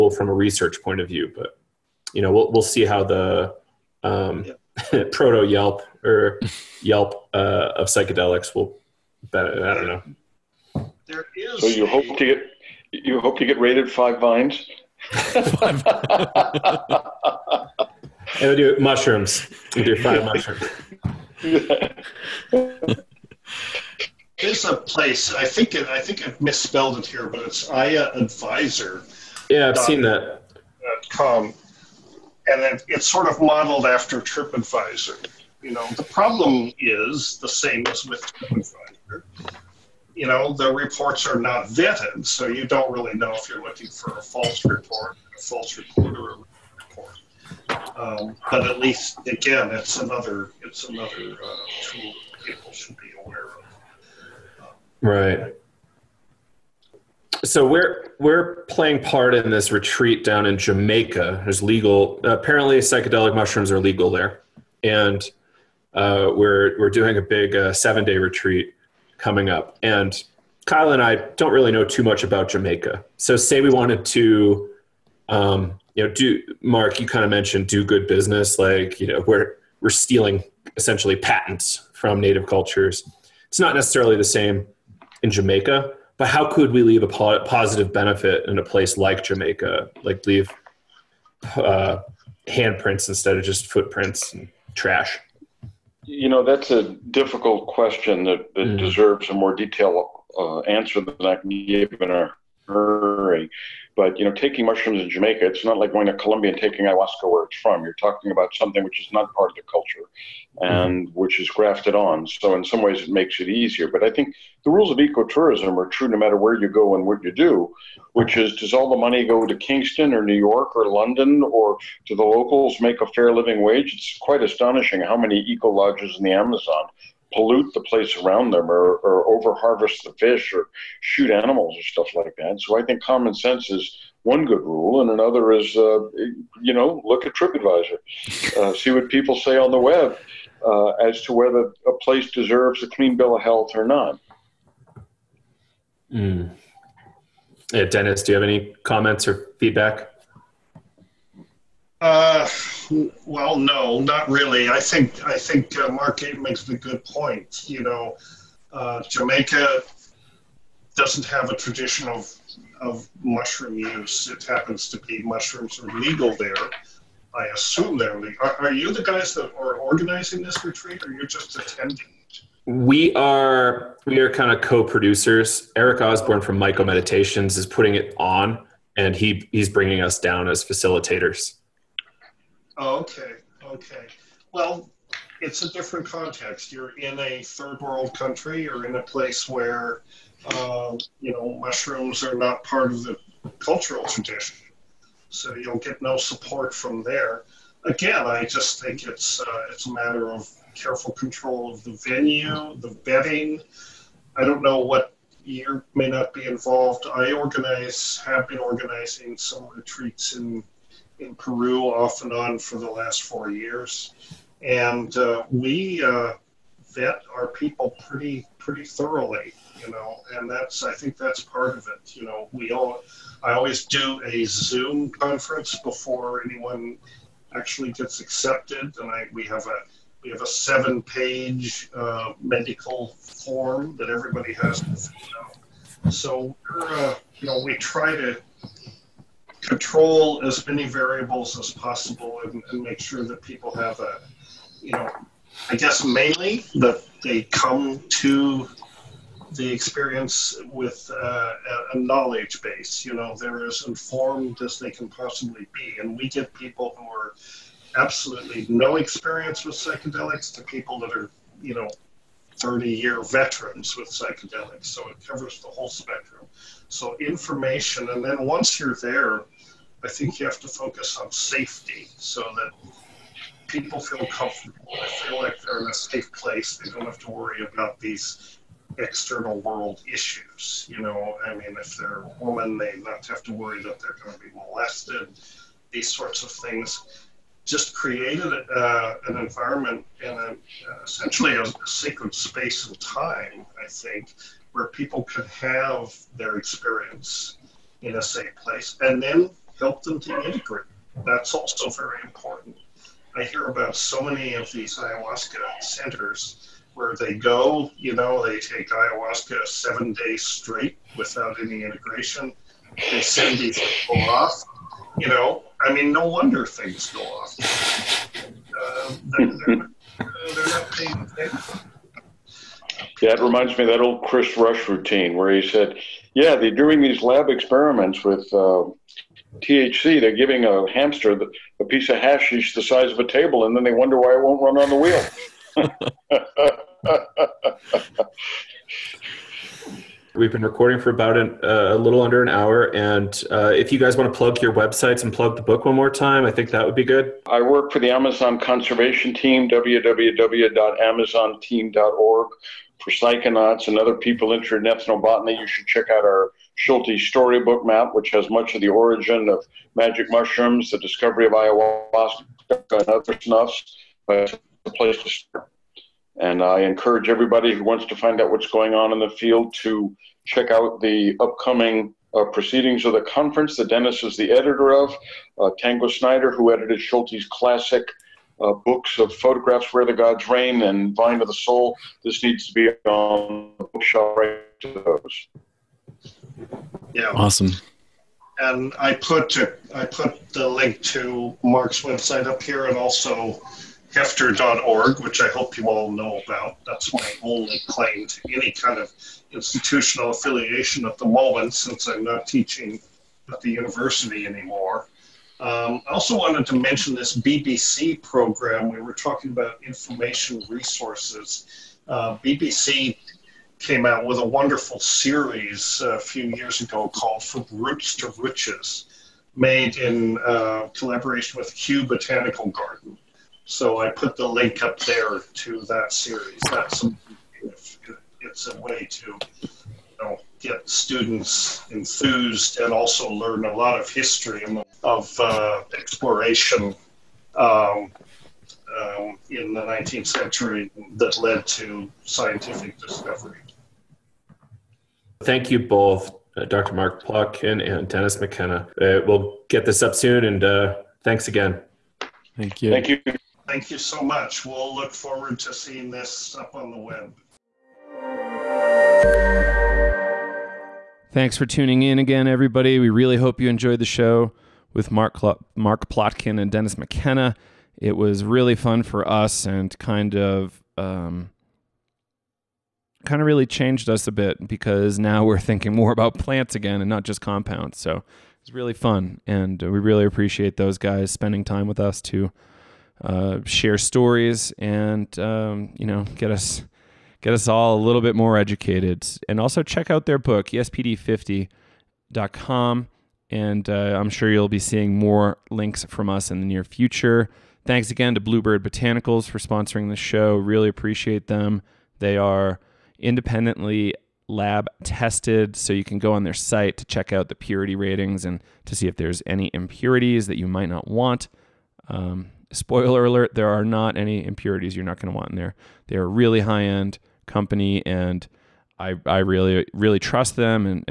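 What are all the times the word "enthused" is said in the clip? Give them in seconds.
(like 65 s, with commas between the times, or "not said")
431 s.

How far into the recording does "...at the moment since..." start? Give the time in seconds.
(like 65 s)
401 s.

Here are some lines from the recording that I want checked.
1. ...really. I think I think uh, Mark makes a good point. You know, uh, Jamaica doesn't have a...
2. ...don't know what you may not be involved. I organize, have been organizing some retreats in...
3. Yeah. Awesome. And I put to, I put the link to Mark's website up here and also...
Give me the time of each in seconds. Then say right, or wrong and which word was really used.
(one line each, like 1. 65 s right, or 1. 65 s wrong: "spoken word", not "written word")
1. 154 s right
2. 204 s right
3. 387 s right.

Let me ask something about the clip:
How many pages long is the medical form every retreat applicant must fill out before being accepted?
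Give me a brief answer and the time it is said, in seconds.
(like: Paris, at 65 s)
7, at 230 s.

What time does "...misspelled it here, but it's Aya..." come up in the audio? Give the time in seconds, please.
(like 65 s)
26 s.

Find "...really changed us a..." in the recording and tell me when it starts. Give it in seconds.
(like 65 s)
473 s.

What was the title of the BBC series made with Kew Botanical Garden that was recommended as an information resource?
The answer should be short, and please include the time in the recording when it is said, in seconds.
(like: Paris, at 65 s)
From Roots to Riches, at 417 s.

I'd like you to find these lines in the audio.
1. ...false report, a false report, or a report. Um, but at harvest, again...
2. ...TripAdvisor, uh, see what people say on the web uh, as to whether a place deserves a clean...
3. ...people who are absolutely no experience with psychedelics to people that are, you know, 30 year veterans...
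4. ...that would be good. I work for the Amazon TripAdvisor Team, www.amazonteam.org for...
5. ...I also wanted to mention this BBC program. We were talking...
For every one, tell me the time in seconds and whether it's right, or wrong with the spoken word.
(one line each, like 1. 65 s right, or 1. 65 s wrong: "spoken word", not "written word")
1. 44 s wrong: "least", not "harvest"
2. 137 s right
3. 256 s right
4. 346 s wrong: "Conservation", not "TripAdvisor"
5. 406 s right.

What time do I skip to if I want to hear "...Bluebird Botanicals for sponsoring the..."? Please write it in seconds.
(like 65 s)
498 s.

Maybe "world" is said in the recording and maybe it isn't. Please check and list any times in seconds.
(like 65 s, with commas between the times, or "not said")
187 s, 279 s.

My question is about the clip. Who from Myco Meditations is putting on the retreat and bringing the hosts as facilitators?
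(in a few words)
Eric Osborne.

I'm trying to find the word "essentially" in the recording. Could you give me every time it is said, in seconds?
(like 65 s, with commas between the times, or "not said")
80 s, 291 s.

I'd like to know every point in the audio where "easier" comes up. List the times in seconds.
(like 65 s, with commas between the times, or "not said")
113 s.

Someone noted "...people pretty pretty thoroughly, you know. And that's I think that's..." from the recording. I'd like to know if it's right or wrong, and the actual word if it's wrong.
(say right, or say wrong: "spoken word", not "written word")
right.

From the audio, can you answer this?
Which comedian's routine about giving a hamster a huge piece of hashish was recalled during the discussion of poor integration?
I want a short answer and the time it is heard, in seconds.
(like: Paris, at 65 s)
Chris Rush, at 324 s.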